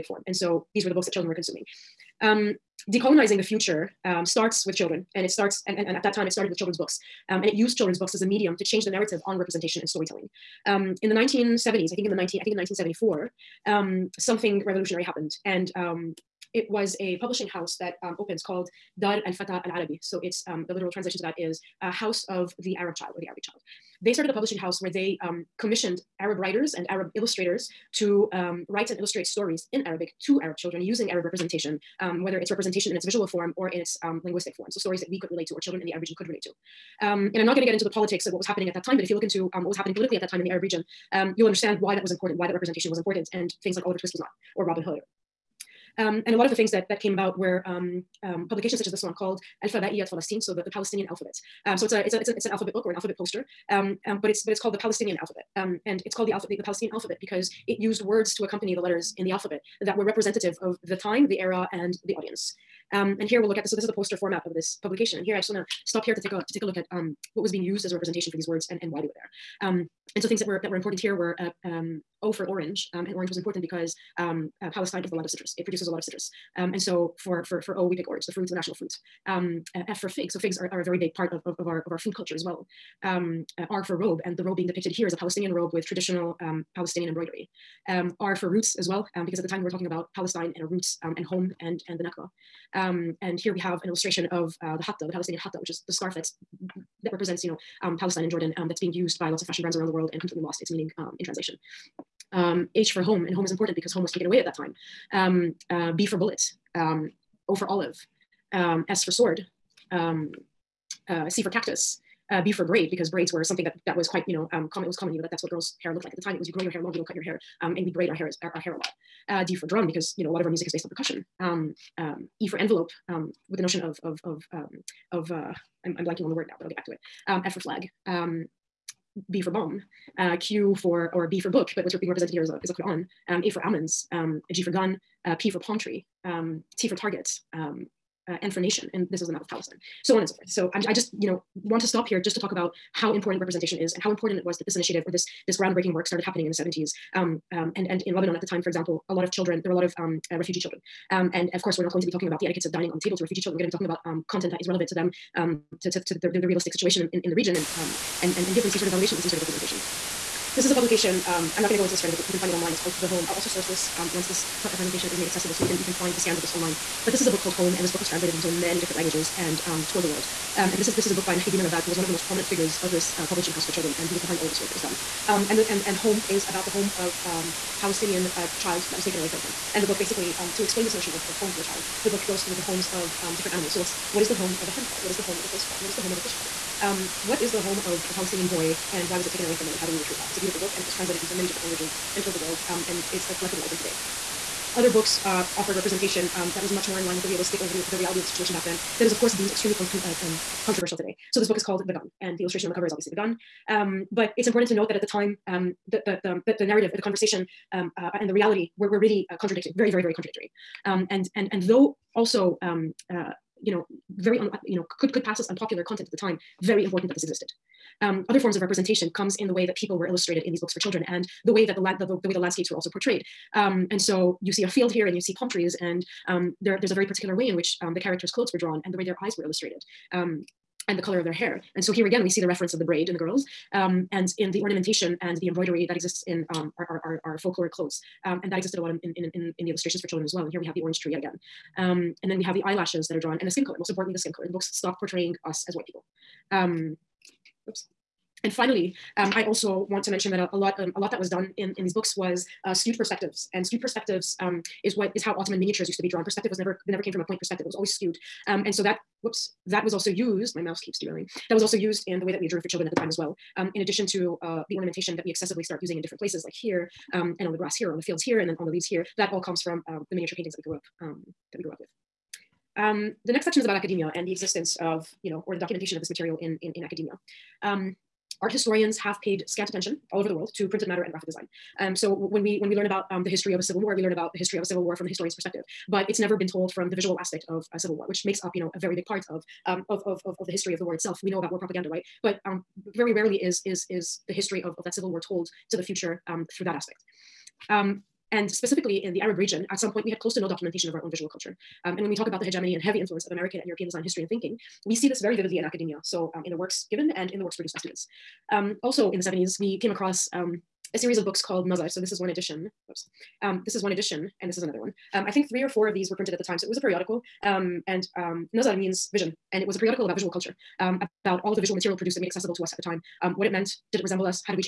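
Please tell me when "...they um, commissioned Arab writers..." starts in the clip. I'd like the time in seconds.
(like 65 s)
24 s.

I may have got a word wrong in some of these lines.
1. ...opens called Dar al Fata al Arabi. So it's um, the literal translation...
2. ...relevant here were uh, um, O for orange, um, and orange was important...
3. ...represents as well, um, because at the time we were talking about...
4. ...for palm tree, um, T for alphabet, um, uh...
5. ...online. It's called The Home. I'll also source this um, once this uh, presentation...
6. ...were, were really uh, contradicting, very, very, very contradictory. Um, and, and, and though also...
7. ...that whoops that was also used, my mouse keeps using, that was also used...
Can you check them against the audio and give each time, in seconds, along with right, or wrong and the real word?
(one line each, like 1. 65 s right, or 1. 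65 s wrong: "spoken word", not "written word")
1. 18 s right
2. 70 s wrong: "important", not "relevant"
3. 88 s wrong: "roots", not "represents"
4. 135 s wrong: "target", not "alphabet"
5. 162 s right
6. 208 s right
7. 258 s wrong: "derailing", not "using".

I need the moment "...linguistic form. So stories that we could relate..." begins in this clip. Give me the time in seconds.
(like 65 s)
34 s.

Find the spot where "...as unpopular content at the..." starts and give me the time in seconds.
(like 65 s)
215 s.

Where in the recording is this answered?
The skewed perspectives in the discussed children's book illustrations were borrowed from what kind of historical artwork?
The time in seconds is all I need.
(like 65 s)
255 s.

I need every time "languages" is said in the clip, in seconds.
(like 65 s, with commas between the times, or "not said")
168 s, 191 s.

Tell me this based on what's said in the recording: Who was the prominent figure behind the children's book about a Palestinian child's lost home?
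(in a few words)
Mohieddin Ellabbad.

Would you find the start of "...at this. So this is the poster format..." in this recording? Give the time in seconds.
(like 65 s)
63 s.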